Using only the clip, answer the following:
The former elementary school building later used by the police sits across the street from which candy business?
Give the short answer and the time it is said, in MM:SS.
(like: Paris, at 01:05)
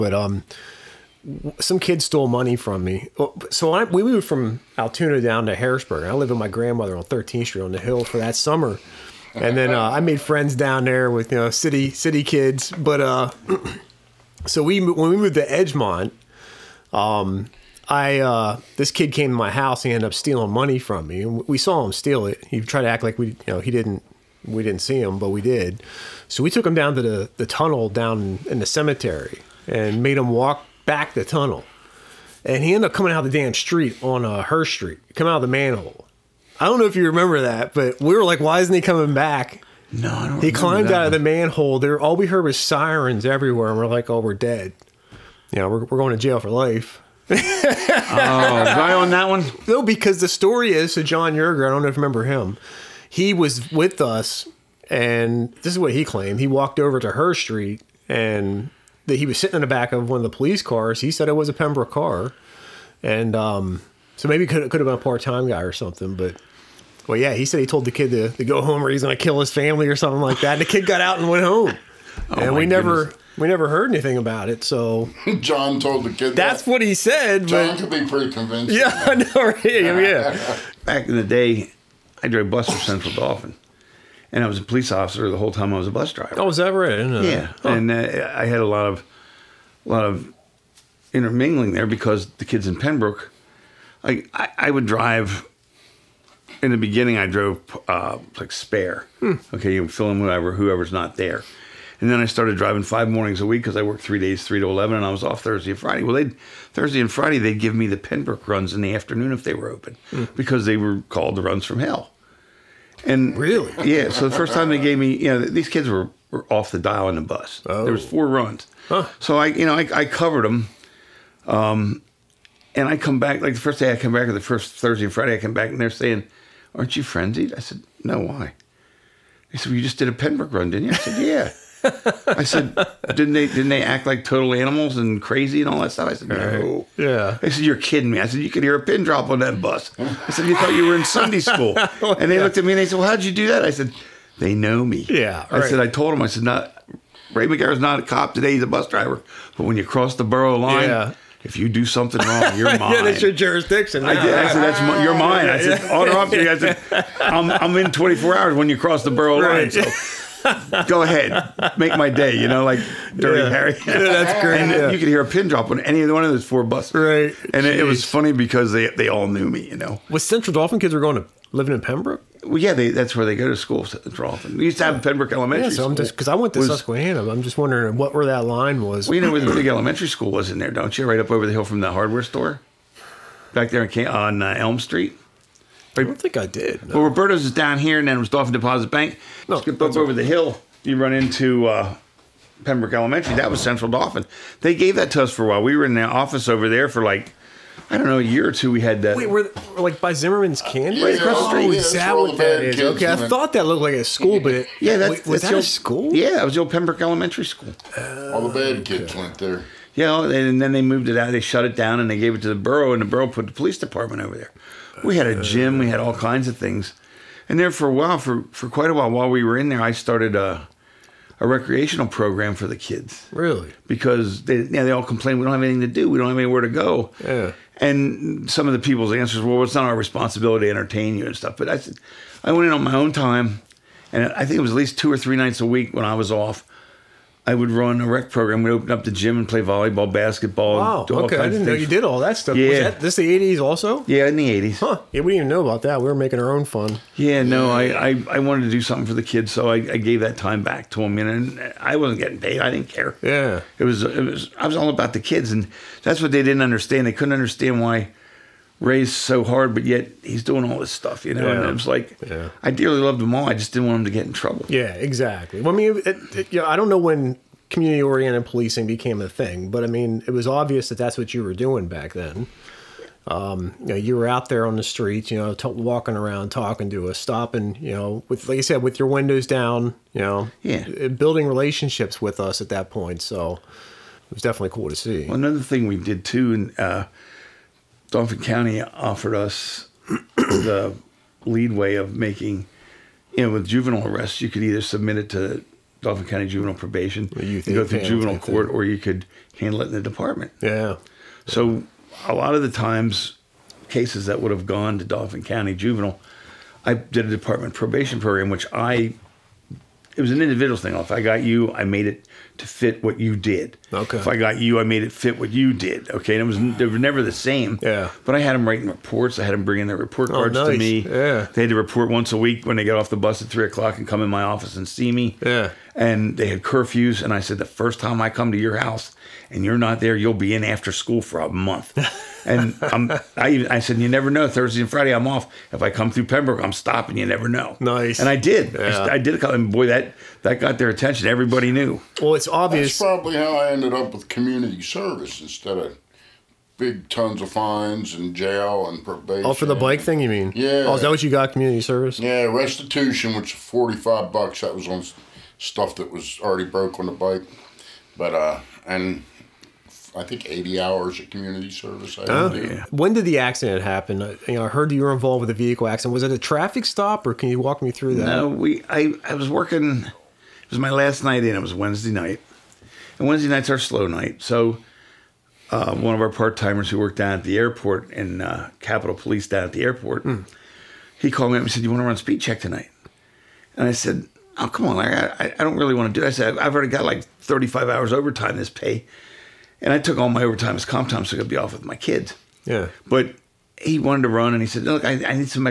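Zimmerman's Candy, at 03:20.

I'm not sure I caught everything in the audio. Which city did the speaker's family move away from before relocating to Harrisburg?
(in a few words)
Altoona.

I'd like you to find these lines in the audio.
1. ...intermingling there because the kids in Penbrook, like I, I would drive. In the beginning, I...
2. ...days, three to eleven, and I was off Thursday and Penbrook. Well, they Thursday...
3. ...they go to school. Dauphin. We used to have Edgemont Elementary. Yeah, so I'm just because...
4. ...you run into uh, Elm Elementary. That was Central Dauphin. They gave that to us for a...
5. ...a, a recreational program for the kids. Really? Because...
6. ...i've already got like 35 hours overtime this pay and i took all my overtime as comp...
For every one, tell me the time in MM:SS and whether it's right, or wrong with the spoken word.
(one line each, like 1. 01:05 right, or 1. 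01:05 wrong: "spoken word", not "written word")
1. 01:31 right
2. 01:44 wrong: "Friday", not "Penbrook"
3. 02:53 wrong: "Penbrook", not "Edgemont"
4. 03:10 wrong: "Penbrook", not "Elm"
5. 03:40 right
6. 06:26 right.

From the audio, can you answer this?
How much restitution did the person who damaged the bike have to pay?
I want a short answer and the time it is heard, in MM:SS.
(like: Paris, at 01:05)
$45, at 05:53.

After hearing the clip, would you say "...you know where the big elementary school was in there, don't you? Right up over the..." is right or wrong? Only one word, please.
right.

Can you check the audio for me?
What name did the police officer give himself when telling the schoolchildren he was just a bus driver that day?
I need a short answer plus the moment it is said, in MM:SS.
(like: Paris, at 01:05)
Ray Magaro, at 02:27.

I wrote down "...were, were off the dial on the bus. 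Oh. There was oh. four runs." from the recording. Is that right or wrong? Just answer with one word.
right.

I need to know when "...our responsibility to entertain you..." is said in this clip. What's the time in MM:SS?
03:49.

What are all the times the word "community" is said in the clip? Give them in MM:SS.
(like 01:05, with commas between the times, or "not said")
04:27, 05:44, 05:51, 06:01.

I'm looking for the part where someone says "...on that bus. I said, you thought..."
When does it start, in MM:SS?
02:19.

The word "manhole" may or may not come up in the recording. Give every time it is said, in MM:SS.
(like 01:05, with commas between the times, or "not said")
00:35, 00:41.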